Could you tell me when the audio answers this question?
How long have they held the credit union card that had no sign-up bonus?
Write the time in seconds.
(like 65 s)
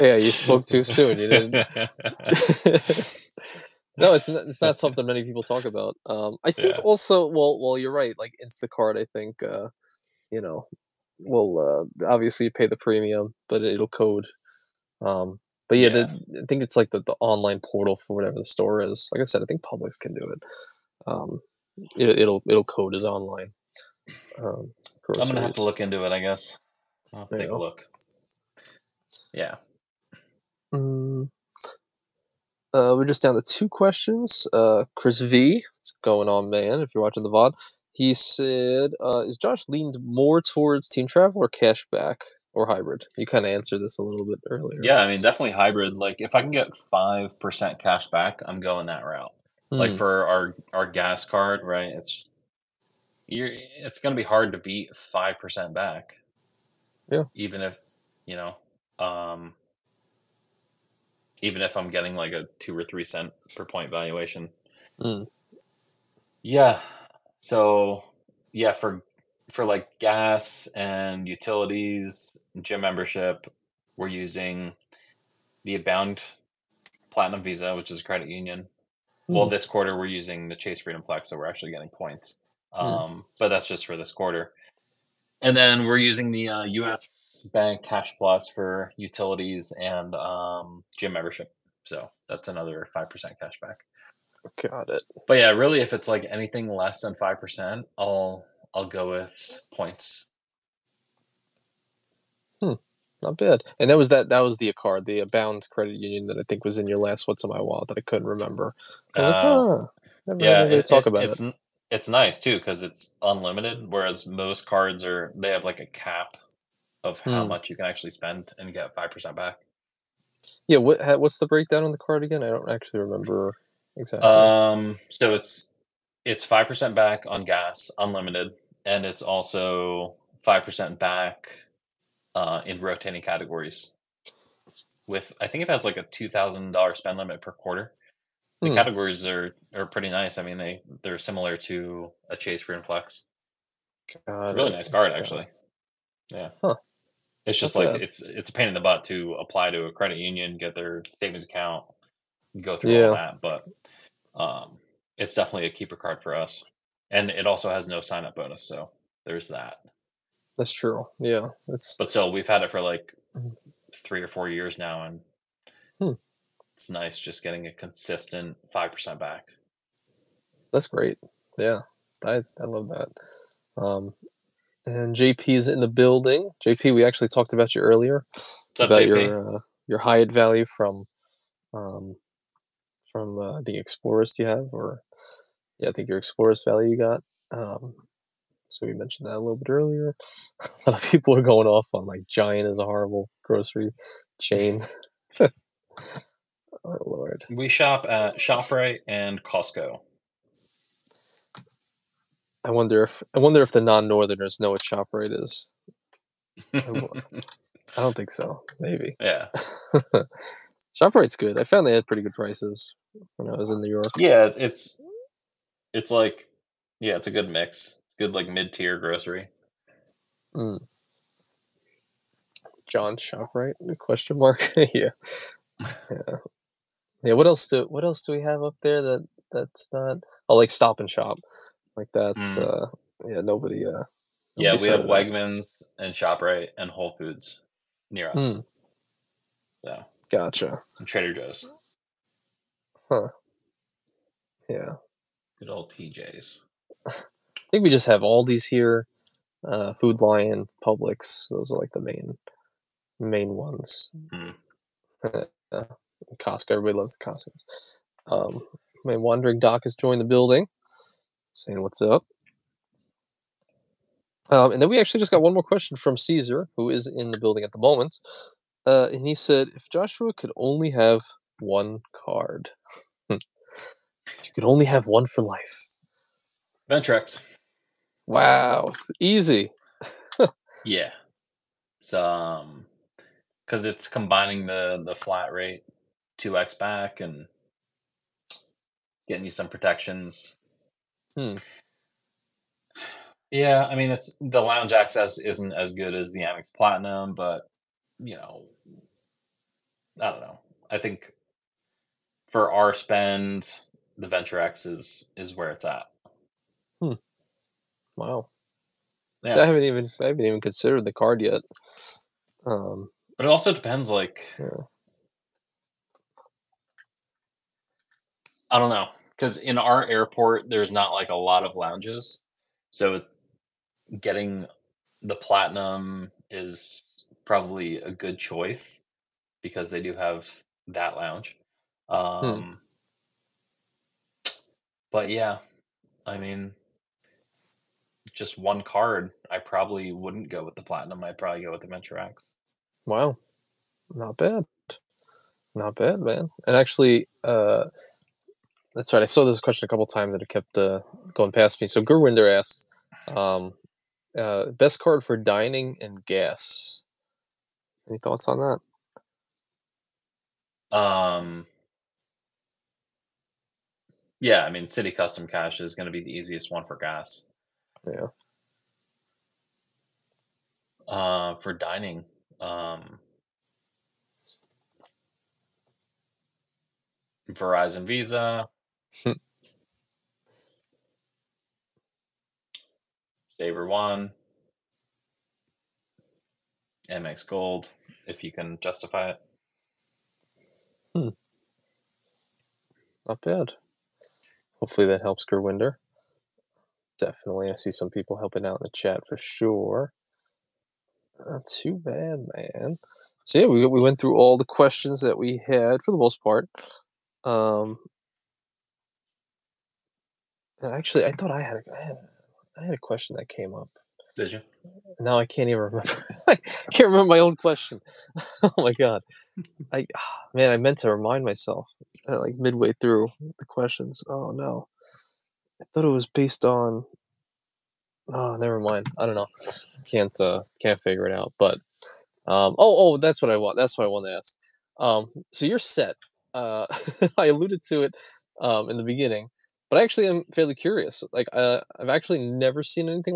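163 s.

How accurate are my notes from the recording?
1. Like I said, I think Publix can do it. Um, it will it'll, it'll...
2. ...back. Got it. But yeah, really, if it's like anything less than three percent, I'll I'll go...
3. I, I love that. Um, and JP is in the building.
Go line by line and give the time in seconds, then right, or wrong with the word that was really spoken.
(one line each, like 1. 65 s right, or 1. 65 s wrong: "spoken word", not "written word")
1. 19 s right
2. 93 s wrong: "five", not "three"
3. 172 s right.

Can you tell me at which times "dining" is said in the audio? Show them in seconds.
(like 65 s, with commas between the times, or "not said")
355 s, 371 s.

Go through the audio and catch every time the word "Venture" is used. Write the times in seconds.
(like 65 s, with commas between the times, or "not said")
276 s, 304 s, 341 s.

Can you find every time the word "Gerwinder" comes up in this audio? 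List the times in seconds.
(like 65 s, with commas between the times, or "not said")
352 s, 395 s.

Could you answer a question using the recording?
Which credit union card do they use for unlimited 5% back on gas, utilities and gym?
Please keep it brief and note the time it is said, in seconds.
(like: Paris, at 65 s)
Abound Platinum Visa, at 75 s.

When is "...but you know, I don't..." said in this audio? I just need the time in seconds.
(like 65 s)
297 s.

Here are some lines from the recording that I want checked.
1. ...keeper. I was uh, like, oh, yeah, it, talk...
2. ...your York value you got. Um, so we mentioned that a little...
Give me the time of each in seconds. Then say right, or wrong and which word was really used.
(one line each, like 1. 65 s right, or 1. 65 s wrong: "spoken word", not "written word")
1. 108 s wrong: "remember", not "keeper"
2. 186 s wrong: "Explorers", not "York".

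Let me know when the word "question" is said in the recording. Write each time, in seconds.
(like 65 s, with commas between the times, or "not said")
33 s, 223 s, 265 s, 349 s, 404 s, 412 s, 417 s, 423 s.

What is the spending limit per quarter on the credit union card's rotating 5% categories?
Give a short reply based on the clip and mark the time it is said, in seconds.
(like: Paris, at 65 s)
$2,000, at 136 s.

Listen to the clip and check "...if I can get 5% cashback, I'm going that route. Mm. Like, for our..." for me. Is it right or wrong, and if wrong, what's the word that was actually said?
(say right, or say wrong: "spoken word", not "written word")
right.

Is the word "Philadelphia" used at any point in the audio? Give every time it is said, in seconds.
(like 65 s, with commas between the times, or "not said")
not said.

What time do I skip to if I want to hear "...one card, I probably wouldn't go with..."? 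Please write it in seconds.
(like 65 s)
338 s.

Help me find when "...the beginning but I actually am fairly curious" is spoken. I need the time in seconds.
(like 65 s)
438 s.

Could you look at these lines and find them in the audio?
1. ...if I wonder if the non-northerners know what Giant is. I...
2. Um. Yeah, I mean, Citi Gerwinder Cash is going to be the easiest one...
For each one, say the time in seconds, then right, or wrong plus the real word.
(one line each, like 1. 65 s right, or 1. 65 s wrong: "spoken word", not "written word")
1. 203 s wrong: "Shoprite", not "Giant"
2. 360 s wrong: "Custom", not "Gerwinder".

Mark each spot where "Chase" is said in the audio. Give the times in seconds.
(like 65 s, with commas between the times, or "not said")
80 s, 142 s.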